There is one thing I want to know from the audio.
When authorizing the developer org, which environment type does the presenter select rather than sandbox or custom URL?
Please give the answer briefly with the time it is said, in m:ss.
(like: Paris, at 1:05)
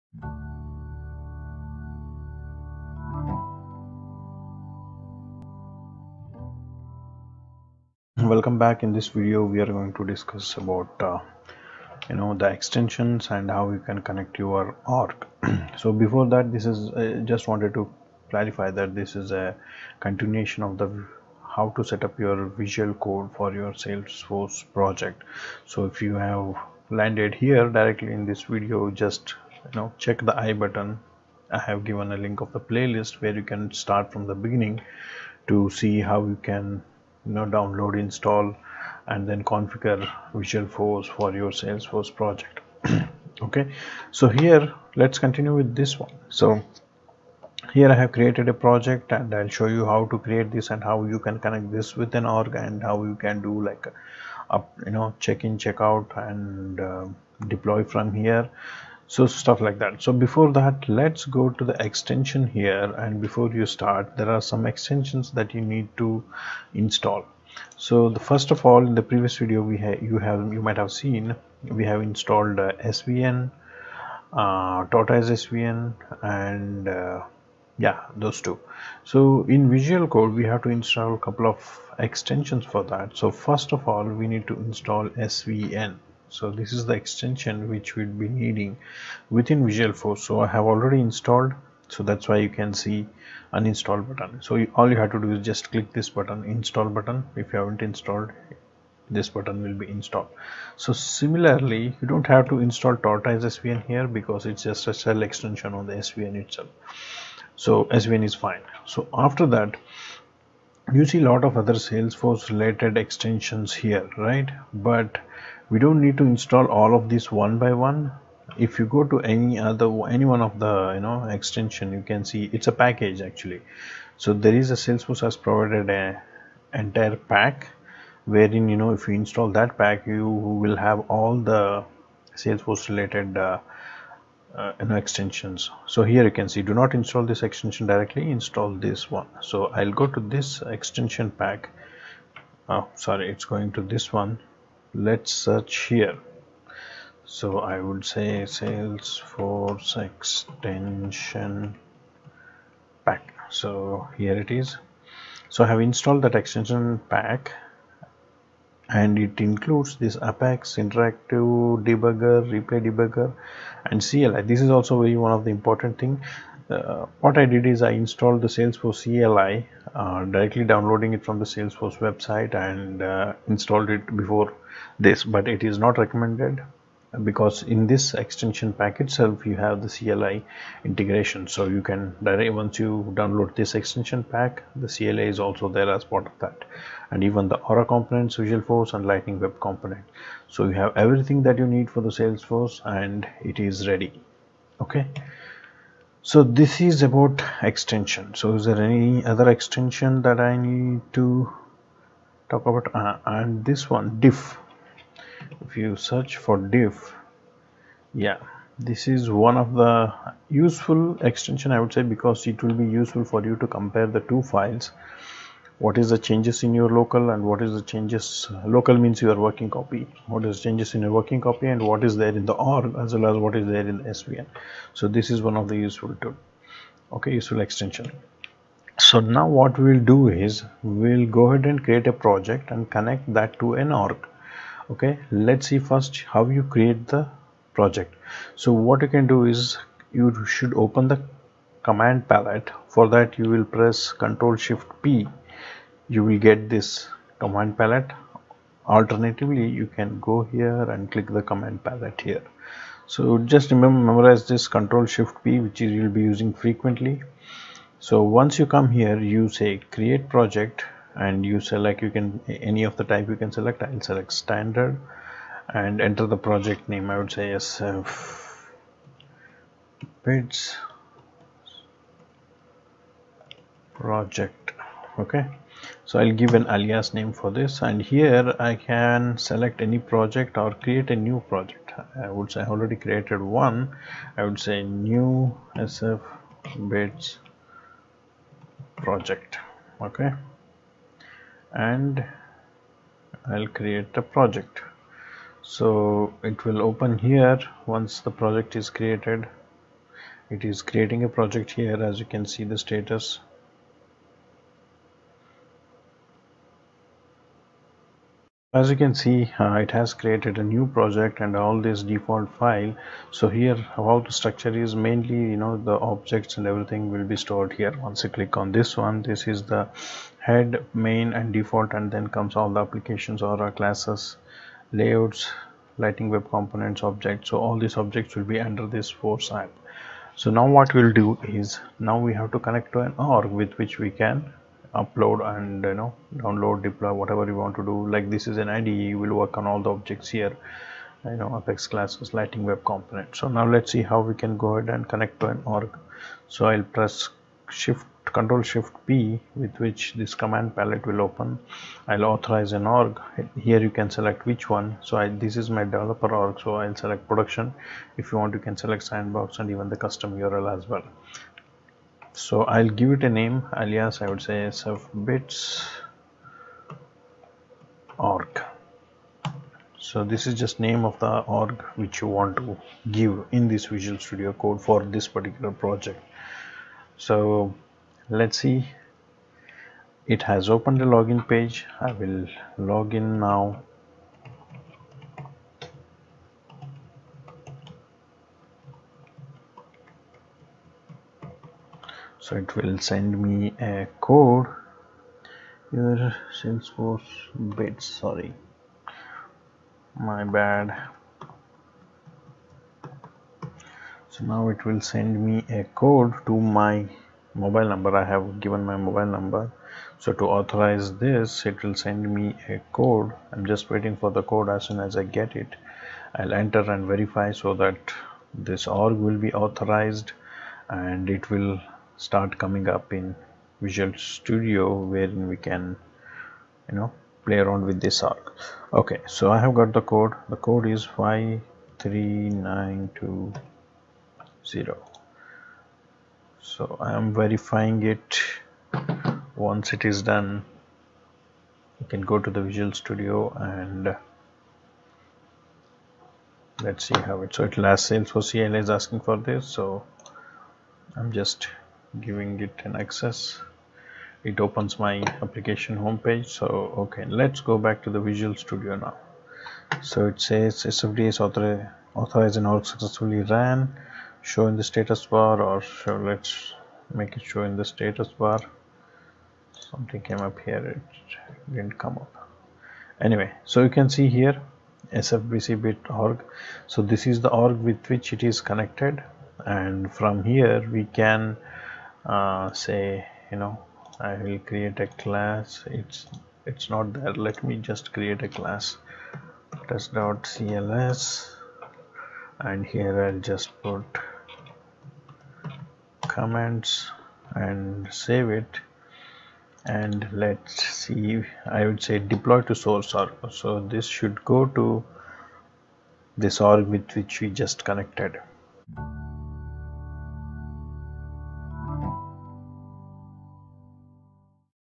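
Production, at 5:57.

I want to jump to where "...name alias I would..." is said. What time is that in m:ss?
6:03.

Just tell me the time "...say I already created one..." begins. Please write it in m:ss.
4:42.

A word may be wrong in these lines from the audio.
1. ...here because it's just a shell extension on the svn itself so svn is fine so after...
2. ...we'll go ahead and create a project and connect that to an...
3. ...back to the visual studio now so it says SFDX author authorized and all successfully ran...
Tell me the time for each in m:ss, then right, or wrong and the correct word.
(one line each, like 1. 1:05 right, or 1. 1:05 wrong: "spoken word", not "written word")
1. 1:43 right
2. 3:51 right
3. 7:37 right.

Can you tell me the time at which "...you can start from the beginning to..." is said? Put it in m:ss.
0:33.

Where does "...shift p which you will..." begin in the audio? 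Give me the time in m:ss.
4:15.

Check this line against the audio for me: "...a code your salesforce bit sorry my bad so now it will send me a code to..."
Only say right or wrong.
right.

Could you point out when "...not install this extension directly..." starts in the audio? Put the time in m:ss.
2:16.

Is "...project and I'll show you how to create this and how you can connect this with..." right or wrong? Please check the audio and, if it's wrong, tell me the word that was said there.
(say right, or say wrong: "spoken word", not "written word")
right.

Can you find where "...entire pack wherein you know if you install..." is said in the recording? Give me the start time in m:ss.
2:06.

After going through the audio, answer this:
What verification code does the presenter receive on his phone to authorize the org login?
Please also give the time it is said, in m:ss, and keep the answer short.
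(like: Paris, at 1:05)
53920, at 7:11.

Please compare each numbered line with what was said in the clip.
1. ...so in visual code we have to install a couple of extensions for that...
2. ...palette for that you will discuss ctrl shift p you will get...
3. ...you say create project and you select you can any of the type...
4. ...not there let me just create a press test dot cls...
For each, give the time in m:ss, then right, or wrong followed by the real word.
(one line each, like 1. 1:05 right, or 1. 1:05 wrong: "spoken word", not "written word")
1. 1:19 right
2. 4:02 wrong: "press", not "discuss"
3. 4:19 right
4. 8:06 wrong: "class", not "press".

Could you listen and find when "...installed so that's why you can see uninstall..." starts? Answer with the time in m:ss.
1:31.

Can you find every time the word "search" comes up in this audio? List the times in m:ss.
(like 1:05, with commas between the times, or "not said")
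2:25, 3:25.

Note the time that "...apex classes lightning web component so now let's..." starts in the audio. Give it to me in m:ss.
5:41.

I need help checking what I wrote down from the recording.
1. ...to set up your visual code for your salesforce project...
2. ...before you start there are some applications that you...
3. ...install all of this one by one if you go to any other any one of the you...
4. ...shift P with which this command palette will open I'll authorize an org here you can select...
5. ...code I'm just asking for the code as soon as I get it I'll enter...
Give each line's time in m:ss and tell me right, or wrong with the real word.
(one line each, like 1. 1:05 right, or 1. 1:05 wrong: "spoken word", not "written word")
1. 0:21 right
2. 1:03 wrong: "extensions", not "applications"
3. 1:56 right
4. 5:48 right
5. 6:53 wrong: "waiting", not "asking".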